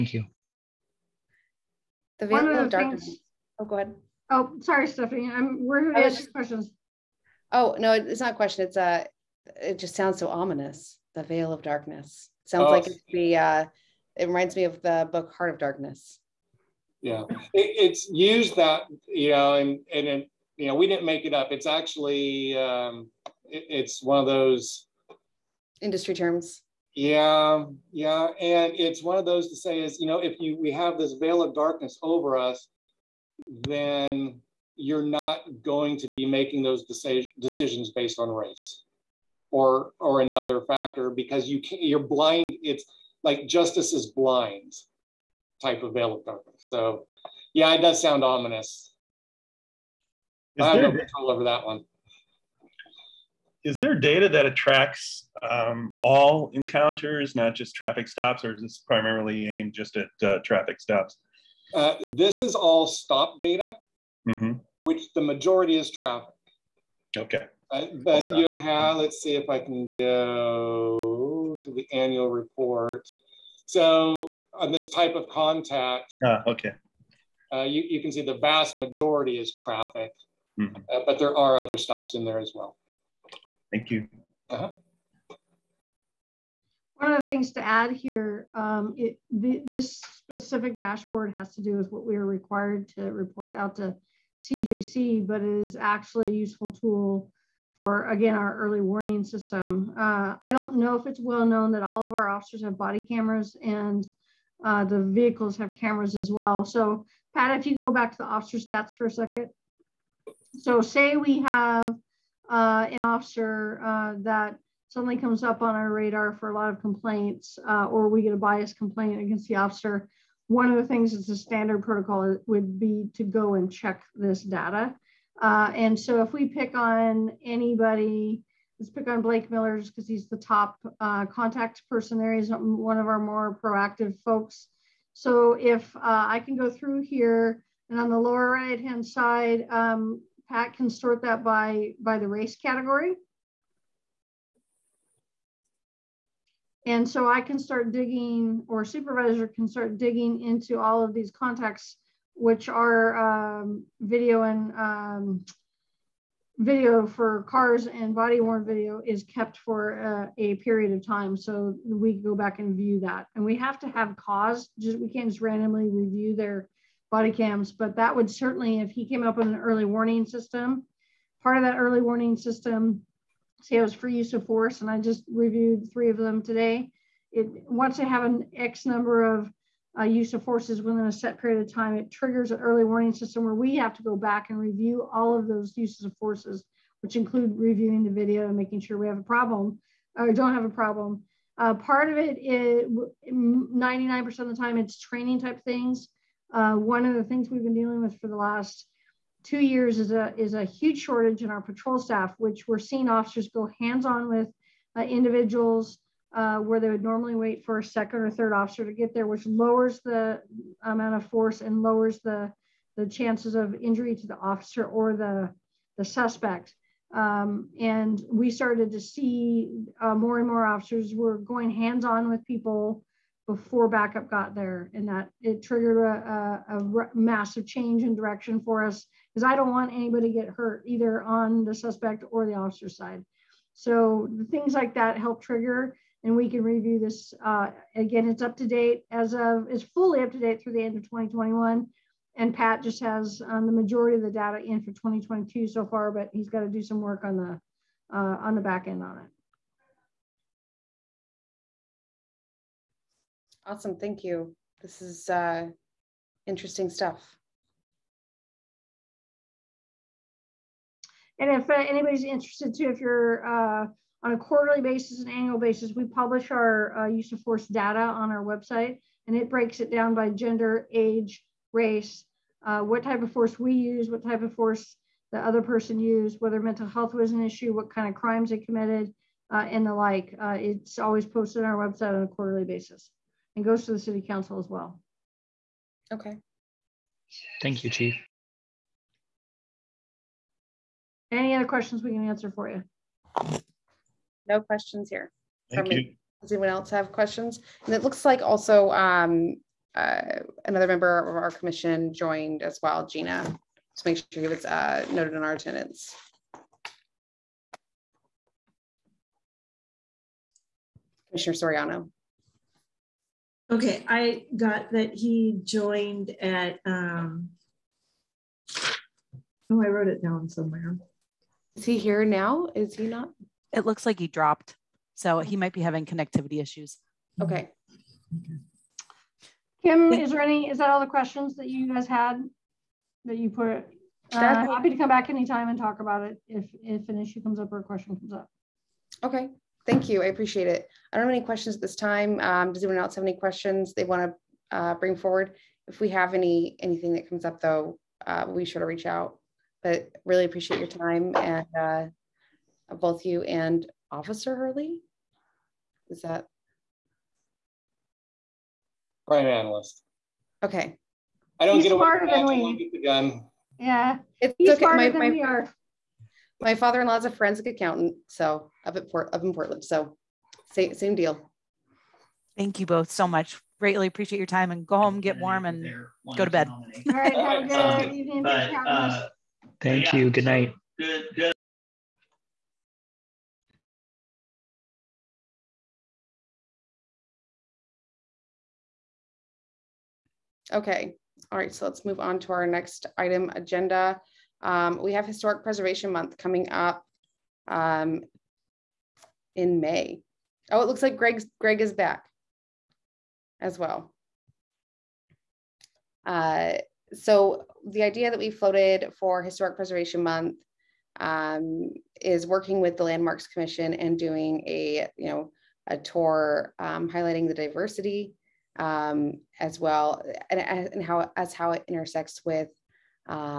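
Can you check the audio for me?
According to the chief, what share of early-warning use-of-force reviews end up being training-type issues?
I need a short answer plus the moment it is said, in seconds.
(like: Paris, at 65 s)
99%, at 193 s.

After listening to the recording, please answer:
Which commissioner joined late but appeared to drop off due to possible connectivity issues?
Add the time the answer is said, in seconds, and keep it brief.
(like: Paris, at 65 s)
Soriano, at 311 s.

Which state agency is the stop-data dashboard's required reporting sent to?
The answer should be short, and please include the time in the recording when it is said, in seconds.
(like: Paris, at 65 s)
CJC, at 94 s.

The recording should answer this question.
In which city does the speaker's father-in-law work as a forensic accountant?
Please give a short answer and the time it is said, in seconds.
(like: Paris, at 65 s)
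Portland, at 369 s.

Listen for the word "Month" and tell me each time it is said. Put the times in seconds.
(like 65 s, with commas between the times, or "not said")
396 s, 410 s.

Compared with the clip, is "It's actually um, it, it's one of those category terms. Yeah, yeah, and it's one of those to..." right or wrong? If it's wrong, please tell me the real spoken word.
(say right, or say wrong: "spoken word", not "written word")
wrong: "industry", not "category".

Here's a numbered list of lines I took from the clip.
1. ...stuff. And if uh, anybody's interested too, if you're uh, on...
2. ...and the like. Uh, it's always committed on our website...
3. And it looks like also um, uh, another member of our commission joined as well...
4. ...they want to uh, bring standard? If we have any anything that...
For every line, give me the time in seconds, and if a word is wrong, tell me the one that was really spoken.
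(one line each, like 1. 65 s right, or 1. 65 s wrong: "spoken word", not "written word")
1. 256 s right
2. 279 s wrong: "posted", not "committed"
3. 297 s right
4. 343 s wrong: "forward", not "standard".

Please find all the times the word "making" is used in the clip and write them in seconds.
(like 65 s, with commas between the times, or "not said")
36 s, 188 s.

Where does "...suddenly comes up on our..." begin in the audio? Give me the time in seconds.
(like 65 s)
114 s.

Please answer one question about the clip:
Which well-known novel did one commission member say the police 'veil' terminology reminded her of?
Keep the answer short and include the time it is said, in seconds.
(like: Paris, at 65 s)
Heart of Darkness, at 15 s.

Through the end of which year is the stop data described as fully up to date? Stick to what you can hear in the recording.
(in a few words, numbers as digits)
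2021.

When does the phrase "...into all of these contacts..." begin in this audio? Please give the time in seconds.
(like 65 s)
150 s.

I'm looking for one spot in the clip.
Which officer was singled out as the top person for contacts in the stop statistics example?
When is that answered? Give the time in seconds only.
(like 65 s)
129 s.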